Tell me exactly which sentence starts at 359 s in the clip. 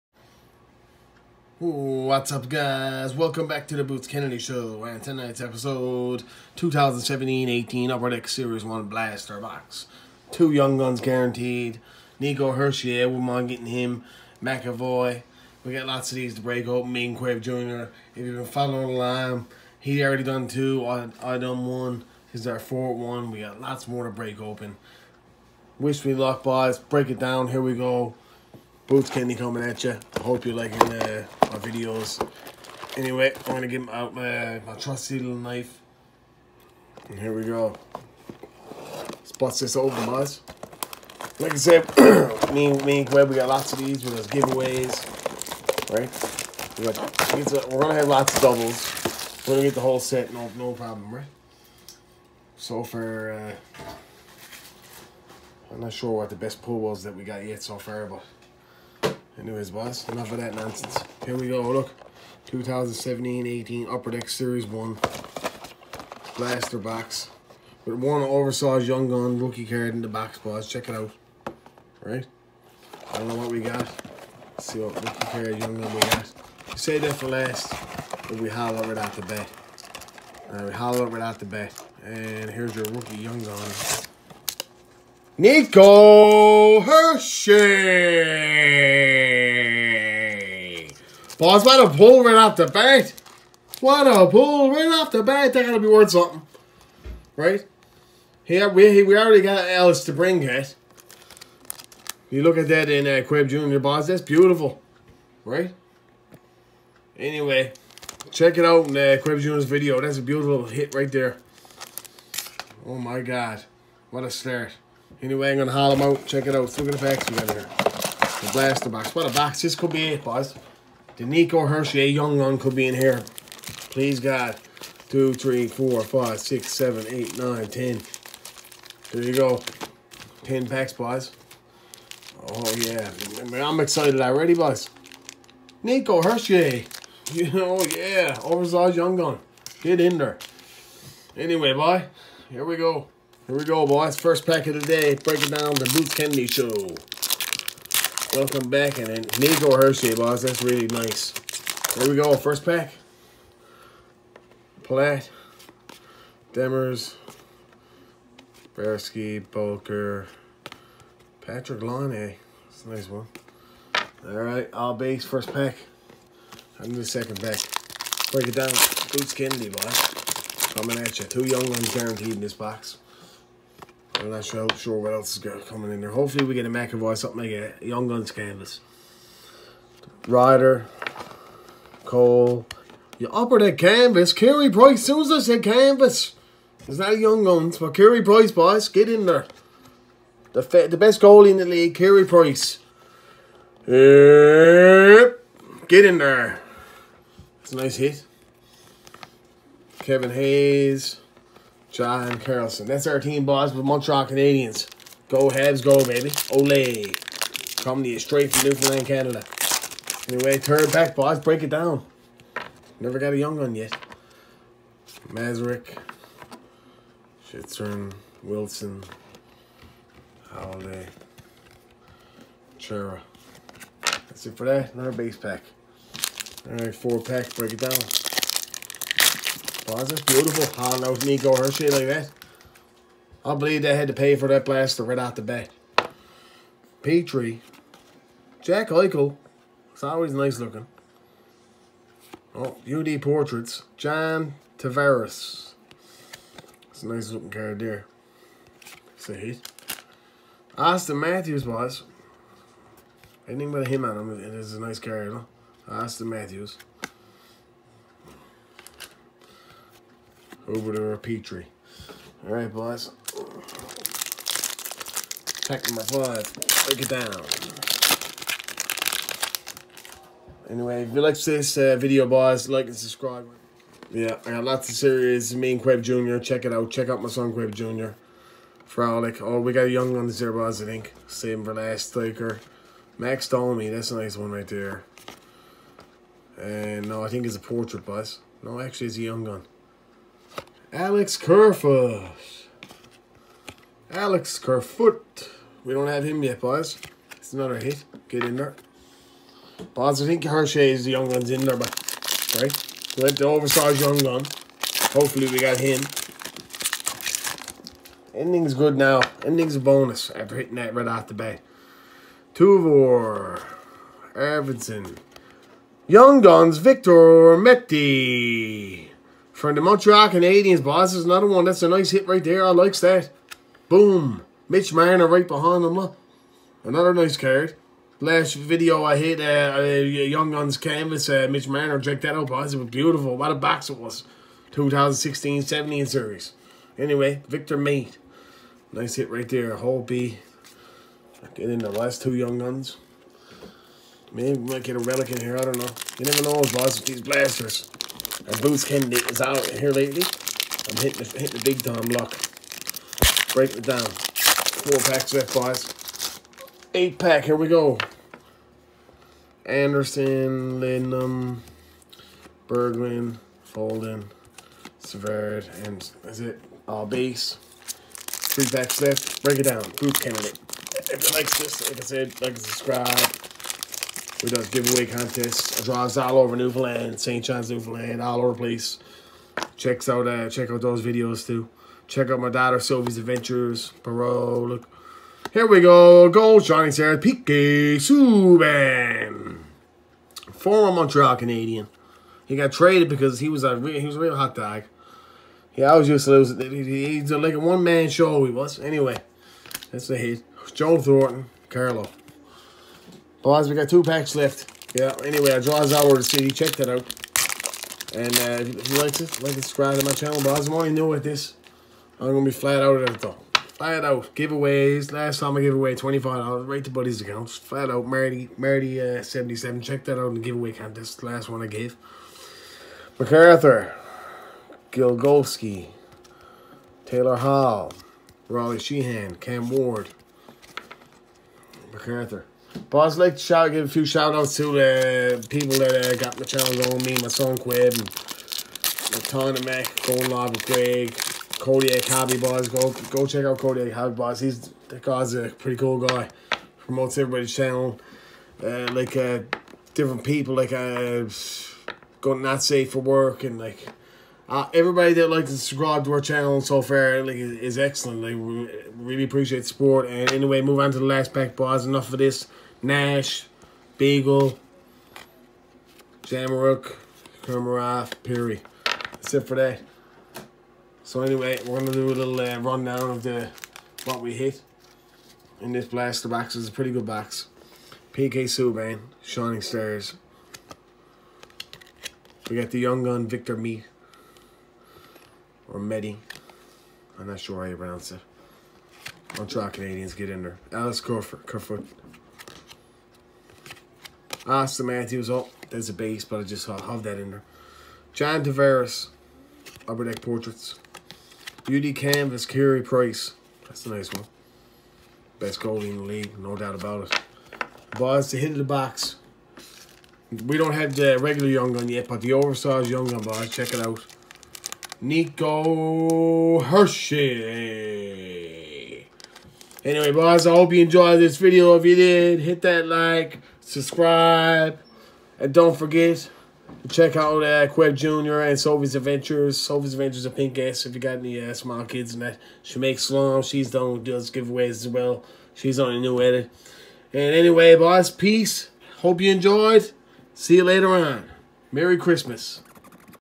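Anderson, Lindum, Berglund, Folden, Severd, and is it all base?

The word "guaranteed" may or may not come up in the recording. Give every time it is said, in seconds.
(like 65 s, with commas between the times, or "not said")
11 s, 171 s.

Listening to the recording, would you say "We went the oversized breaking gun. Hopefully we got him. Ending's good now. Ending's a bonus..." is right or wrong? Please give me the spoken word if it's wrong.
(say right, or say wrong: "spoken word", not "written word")
wrong: "young", not "breaking".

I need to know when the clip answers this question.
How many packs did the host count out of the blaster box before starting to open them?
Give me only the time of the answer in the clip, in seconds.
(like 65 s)
130 s.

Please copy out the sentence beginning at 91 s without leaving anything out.
Boss, what a pull right off the bat.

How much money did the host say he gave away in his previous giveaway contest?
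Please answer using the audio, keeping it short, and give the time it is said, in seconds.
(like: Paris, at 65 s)
$25, at 415 s.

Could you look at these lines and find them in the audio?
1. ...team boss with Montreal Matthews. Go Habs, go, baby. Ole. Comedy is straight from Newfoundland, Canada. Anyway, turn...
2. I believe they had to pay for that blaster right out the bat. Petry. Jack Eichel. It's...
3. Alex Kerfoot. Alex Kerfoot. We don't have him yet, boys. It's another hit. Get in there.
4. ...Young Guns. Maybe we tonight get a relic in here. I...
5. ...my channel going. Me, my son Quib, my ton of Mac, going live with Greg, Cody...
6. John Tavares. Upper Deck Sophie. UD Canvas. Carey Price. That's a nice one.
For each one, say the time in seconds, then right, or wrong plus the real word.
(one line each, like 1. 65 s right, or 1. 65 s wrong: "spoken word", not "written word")
1. 203 s wrong: "Canadiens", not "Matthews"
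2. 233 s right
3. 290 s right
4. 342 s wrong: "might", not "tonight"
5. 436 s right
6. 498 s wrong: "Portraits", not "Sophie".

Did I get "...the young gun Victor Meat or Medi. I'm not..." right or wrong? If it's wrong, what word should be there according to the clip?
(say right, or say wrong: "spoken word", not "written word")
right.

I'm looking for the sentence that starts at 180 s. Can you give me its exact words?
Ryder, Cole, you upper that canvas.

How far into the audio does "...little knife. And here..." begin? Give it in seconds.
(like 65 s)
35 s.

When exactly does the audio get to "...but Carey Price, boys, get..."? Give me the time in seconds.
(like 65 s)
187 s.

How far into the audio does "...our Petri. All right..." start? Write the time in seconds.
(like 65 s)
261 s.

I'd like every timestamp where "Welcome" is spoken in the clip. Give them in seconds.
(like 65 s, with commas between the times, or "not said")
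3 s, 148 s.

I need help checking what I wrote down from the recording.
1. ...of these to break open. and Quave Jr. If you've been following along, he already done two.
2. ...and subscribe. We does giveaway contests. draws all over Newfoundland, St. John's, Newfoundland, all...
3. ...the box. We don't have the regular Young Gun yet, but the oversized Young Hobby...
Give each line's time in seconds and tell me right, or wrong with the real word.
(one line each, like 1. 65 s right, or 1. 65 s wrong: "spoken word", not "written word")
1. 16 s right
2. 372 s right
3. 508 s wrong: "Gun", not "Hobby".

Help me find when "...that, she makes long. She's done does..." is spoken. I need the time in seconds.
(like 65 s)
532 s.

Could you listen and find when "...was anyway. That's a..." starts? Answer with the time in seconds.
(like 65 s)
398 s.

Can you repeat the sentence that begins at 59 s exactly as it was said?
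Anyways, boss, enough of that nonsense.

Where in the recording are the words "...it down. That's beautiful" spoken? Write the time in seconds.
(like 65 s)
227 s.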